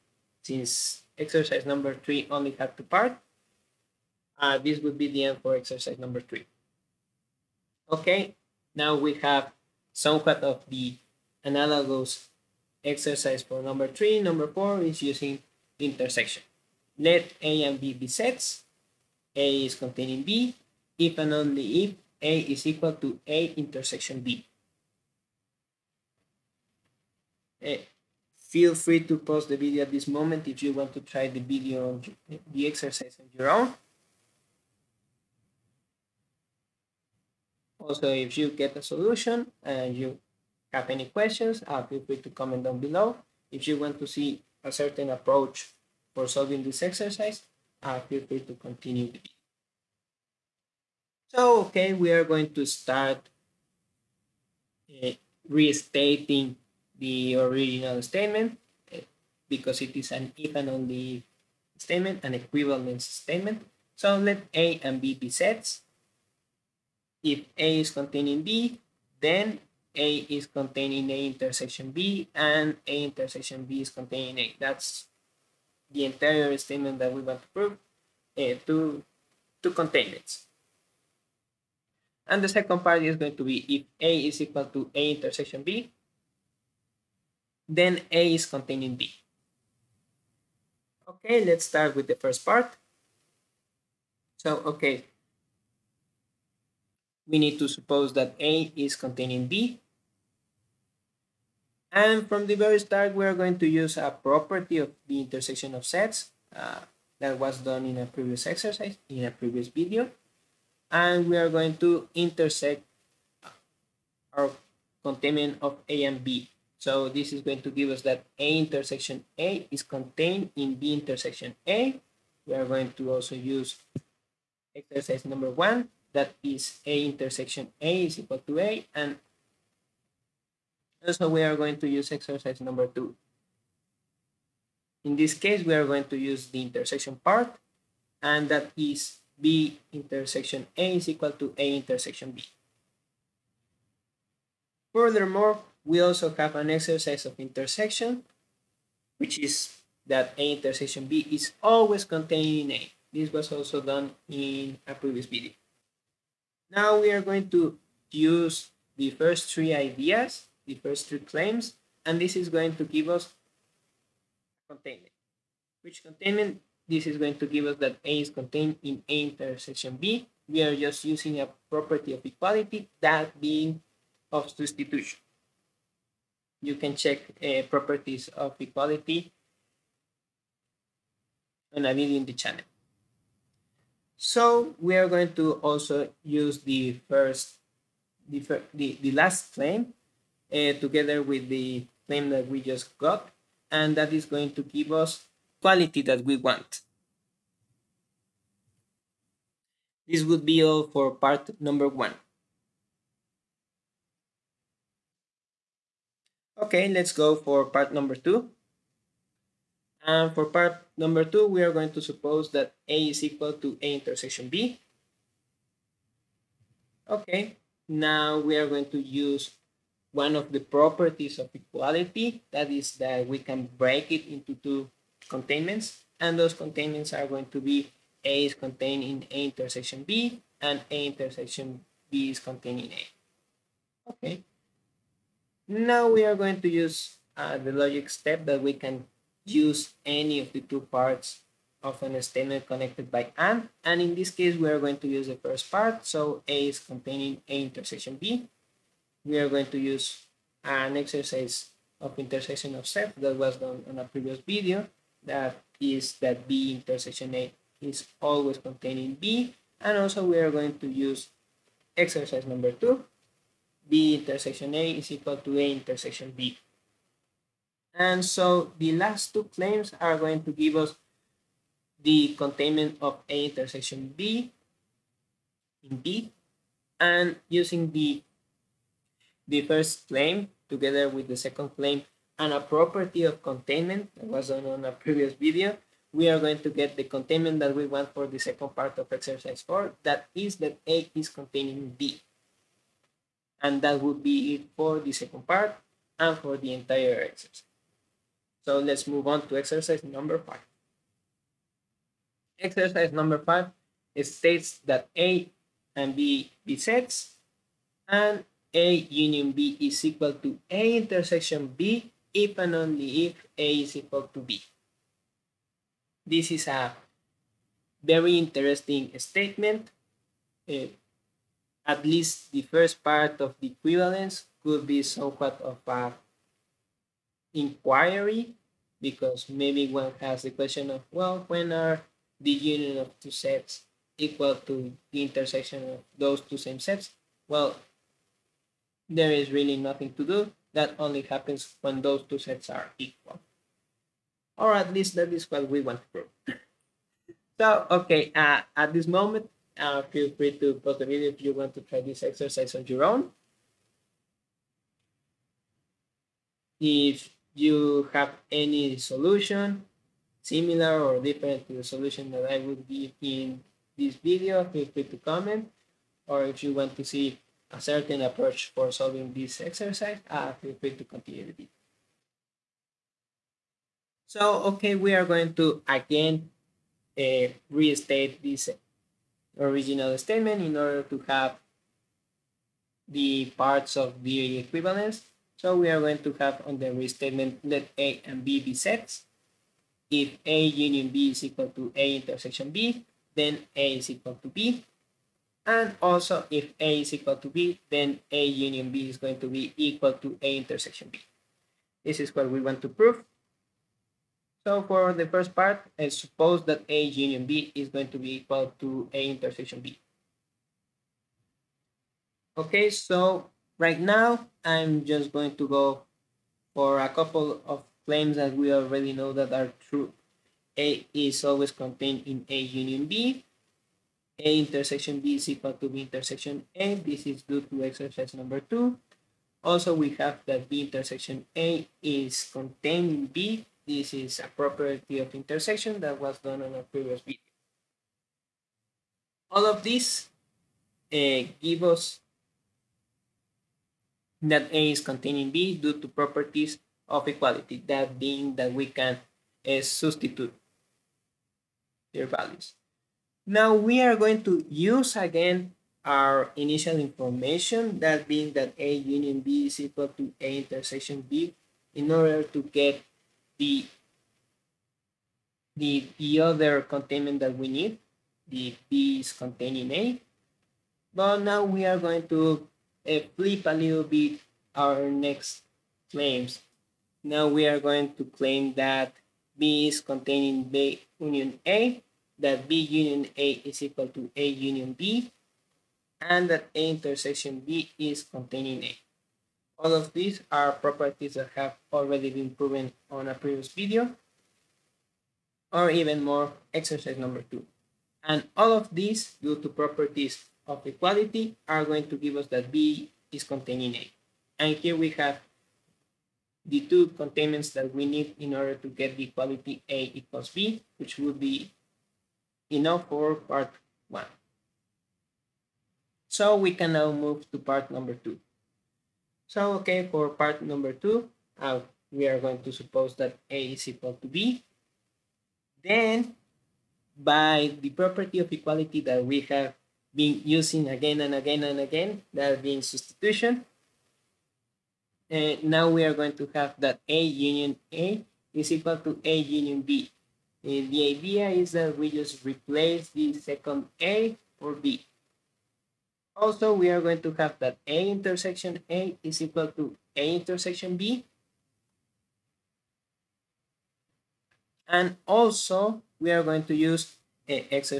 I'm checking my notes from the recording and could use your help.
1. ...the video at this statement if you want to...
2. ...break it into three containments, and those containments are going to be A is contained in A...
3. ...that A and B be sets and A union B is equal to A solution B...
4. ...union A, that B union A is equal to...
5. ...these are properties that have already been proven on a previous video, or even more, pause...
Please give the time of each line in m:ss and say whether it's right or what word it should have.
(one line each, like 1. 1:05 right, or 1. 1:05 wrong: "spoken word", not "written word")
1. 0:29 wrong: "moment", not "statement"
2. 3:43 wrong: "two", not "three"
3. 5:04 wrong: "intersection", not "solution"
4. 8:01 right
5. 8:10 wrong: "exercise", not "pause".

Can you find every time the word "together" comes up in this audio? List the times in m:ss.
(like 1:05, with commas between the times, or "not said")
3:10, 4:40.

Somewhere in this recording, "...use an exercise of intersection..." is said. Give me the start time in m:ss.
4:09.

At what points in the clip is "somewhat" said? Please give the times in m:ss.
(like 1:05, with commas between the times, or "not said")
0:09, 5:25.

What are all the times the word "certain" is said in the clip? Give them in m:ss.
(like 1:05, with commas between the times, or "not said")
0:44, 6:07.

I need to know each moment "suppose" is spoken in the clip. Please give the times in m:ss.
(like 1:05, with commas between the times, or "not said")
1:37, 3:32, 6:46, 8:42.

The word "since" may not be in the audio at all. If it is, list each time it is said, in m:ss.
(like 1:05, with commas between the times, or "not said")
0:00.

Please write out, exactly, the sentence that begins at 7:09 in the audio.
Also, we have that B intersection A is contained in B.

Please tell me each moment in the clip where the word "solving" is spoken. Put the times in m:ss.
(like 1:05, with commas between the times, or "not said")
0:46, 6:08.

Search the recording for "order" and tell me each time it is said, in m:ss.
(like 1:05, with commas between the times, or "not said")
6:20, 7:42, 8:28.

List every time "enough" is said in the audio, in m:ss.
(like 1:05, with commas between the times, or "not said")
8:32.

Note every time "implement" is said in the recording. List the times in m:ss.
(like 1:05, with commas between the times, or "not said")
not said.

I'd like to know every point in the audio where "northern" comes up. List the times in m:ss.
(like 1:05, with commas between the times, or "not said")
not said.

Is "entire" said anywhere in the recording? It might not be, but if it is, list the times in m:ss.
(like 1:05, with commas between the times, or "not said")
1:16, 4:56.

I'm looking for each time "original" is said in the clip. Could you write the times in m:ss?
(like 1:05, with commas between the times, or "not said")
0:57, 6:19.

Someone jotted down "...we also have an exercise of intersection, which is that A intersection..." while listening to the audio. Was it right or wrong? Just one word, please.
right.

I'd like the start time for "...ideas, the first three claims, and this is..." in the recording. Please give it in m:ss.
2:39.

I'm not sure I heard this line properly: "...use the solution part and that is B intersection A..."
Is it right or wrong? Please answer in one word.
wrong.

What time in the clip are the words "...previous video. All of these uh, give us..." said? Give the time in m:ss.
7:16.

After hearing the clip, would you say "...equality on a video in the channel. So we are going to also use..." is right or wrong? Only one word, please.
right.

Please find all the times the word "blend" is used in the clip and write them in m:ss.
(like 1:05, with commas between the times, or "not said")
not said.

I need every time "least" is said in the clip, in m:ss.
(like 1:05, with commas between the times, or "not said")
5:22, 5:44.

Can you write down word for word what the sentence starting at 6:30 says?
If A union B is equal to A intersection B, then A is equal to B.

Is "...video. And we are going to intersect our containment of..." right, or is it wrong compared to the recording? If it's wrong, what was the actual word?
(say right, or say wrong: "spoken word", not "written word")
right.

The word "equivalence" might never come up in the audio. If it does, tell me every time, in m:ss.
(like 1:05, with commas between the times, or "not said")
1:02, 5:23, 6:24.